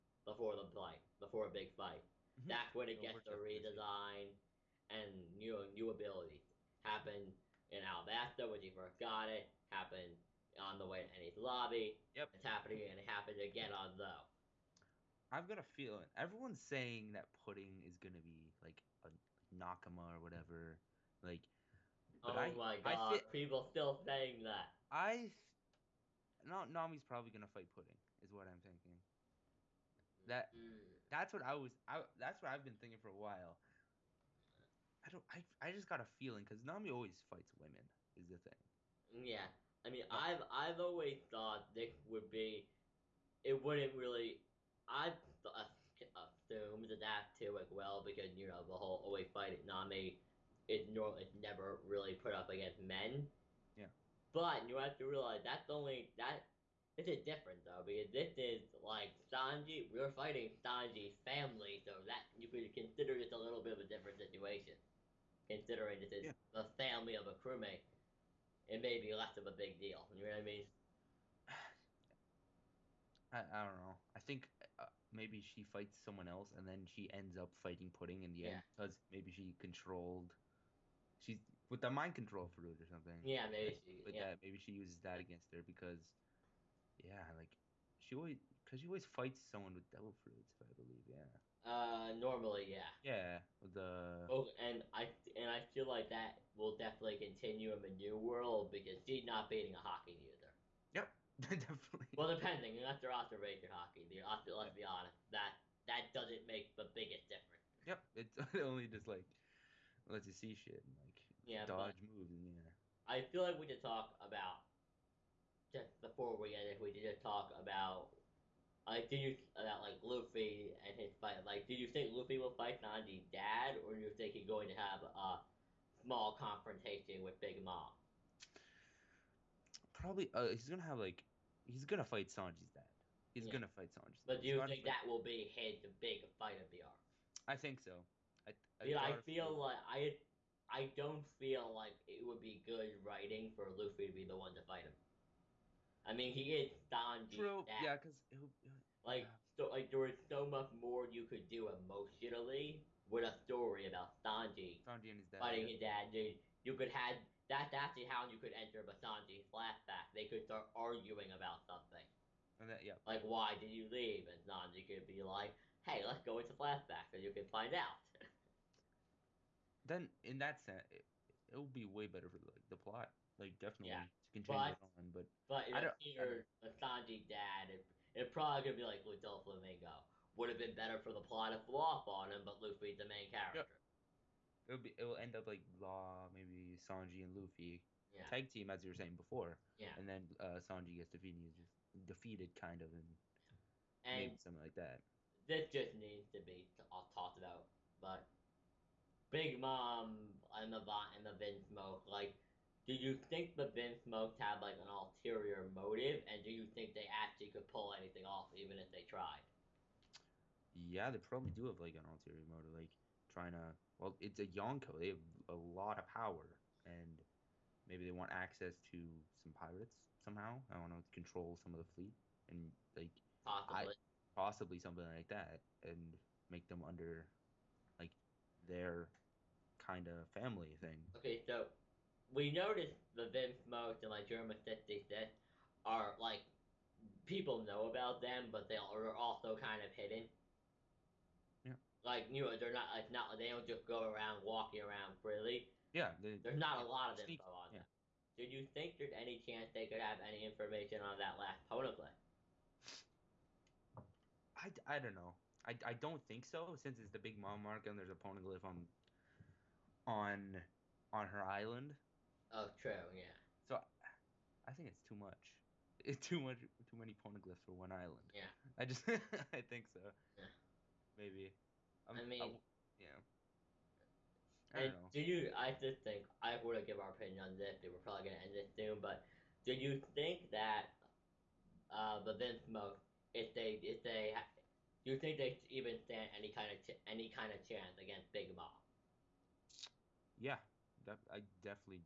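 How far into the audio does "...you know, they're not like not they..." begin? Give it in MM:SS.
04:02.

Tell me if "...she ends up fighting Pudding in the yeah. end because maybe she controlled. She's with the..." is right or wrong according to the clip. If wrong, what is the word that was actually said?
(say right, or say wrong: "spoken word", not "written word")
right.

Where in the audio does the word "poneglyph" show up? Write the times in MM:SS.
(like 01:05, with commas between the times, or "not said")
04:11, 04:18, 04:27.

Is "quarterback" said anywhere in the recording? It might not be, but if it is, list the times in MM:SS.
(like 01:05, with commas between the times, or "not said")
not said.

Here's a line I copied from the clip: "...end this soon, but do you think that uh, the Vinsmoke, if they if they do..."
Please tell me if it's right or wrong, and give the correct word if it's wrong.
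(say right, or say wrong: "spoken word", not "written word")
right.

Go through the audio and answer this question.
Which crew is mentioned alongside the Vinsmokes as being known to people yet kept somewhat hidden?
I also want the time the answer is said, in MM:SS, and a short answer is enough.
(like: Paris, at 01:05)
Germa 66, at 03:54.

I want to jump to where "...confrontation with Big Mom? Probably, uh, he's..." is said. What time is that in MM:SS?
02:06.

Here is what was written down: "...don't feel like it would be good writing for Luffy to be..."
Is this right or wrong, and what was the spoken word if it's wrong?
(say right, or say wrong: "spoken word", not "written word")
right.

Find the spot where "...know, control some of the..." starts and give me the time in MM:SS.
03:40.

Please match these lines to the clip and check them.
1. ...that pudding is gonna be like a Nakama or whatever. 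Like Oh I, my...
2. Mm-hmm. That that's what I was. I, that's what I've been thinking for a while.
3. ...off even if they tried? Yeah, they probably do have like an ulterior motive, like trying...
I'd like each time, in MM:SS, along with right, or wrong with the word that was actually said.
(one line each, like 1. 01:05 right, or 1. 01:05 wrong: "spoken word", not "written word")
1. 00:17 right
2. 00:30 right
3. 03:28 right.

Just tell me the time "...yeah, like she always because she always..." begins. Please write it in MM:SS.
01:27.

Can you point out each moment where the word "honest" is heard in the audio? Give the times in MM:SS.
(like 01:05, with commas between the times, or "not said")
01:44.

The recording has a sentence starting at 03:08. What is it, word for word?
tag team as you were saying before.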